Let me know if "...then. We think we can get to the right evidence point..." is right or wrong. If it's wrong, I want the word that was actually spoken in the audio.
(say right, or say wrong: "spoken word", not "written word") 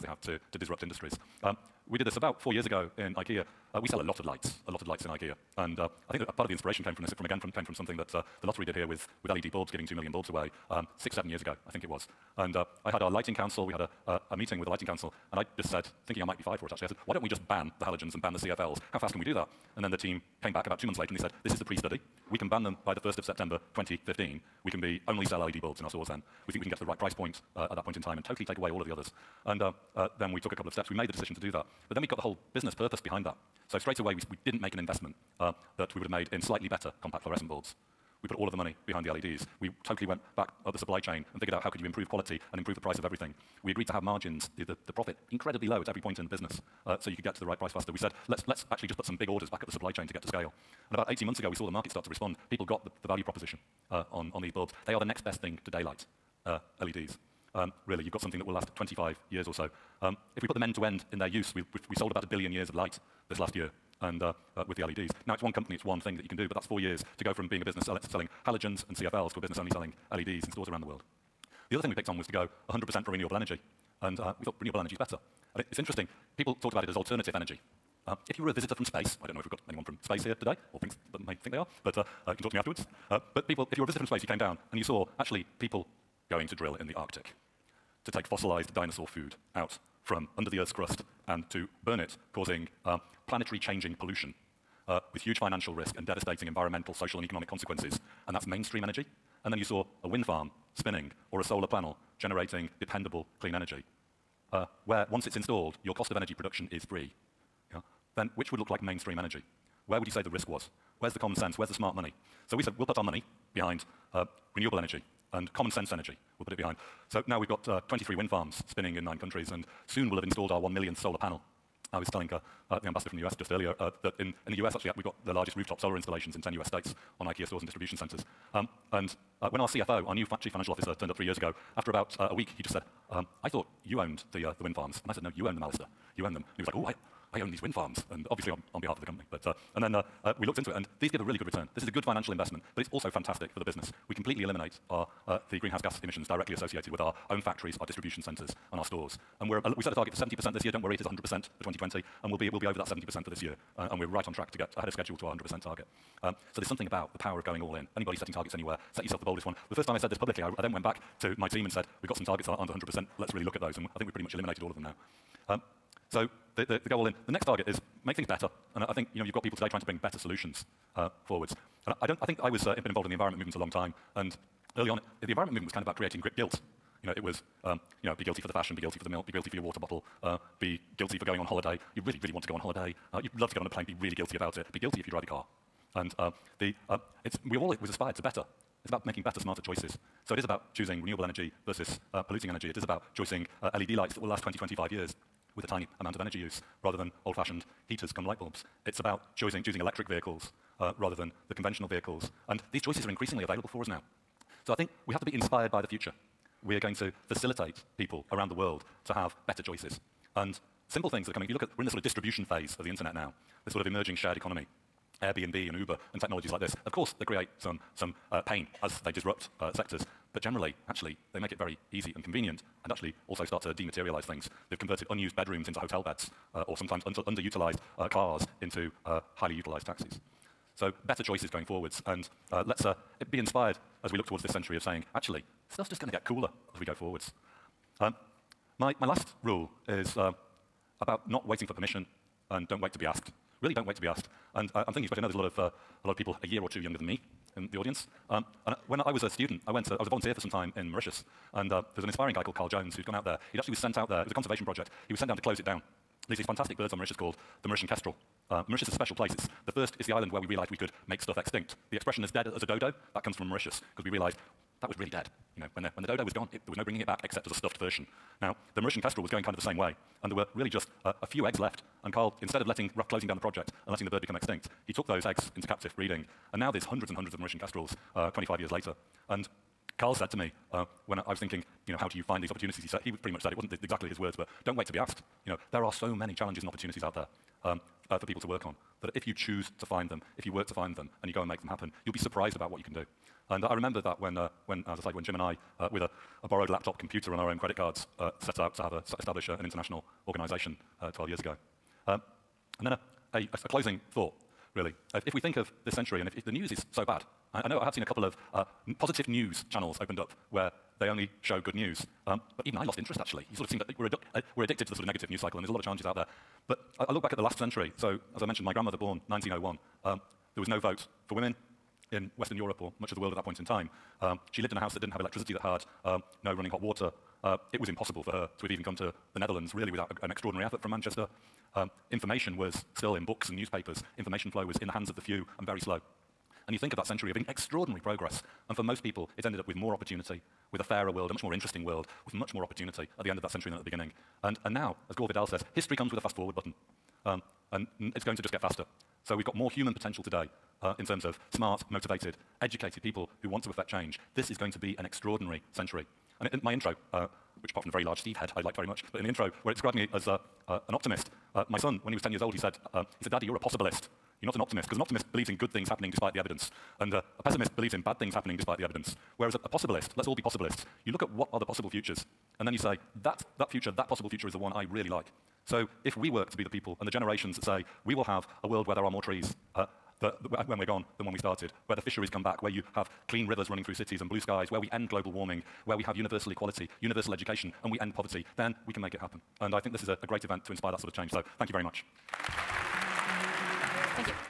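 wrong: "price", not "evidence".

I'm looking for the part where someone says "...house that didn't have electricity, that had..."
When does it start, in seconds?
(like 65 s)
324 s.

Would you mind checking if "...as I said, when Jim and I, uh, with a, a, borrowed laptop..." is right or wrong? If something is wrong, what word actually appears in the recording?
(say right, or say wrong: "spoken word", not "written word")
right.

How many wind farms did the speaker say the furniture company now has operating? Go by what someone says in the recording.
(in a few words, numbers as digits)
23.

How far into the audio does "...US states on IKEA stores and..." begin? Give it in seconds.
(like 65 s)
126 s.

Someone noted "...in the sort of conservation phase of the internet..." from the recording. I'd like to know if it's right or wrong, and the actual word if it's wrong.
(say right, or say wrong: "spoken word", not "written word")
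wrong: "distribution", not "conservation".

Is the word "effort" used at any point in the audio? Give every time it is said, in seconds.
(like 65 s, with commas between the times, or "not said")
330 s.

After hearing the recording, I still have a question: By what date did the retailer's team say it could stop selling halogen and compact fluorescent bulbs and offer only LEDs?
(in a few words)
1st of September 2015.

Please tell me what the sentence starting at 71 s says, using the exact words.
The other thing we picked on was to go 100% for renewable energy.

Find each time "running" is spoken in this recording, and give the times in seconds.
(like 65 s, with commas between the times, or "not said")
326 s, 383 s.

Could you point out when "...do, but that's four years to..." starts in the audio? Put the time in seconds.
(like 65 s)
66 s.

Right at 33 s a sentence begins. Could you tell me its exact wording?
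So straight away, we, we didn't make an investment uh, that we would have made in slightly better compact fluorescent bulbs.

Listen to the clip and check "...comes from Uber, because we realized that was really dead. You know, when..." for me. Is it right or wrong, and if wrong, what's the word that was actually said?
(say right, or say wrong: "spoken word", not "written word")
wrong: "Mauritius", not "Uber".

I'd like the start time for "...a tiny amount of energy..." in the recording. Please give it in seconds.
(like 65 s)
195 s.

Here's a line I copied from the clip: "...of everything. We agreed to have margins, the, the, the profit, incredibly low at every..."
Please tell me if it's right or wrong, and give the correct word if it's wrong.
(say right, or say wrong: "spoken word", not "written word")
right.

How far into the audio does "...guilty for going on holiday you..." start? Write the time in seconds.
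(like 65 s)
180 s.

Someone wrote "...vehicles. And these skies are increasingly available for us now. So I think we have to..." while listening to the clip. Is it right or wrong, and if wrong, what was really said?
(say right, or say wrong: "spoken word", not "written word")
wrong: "choices", not "skies".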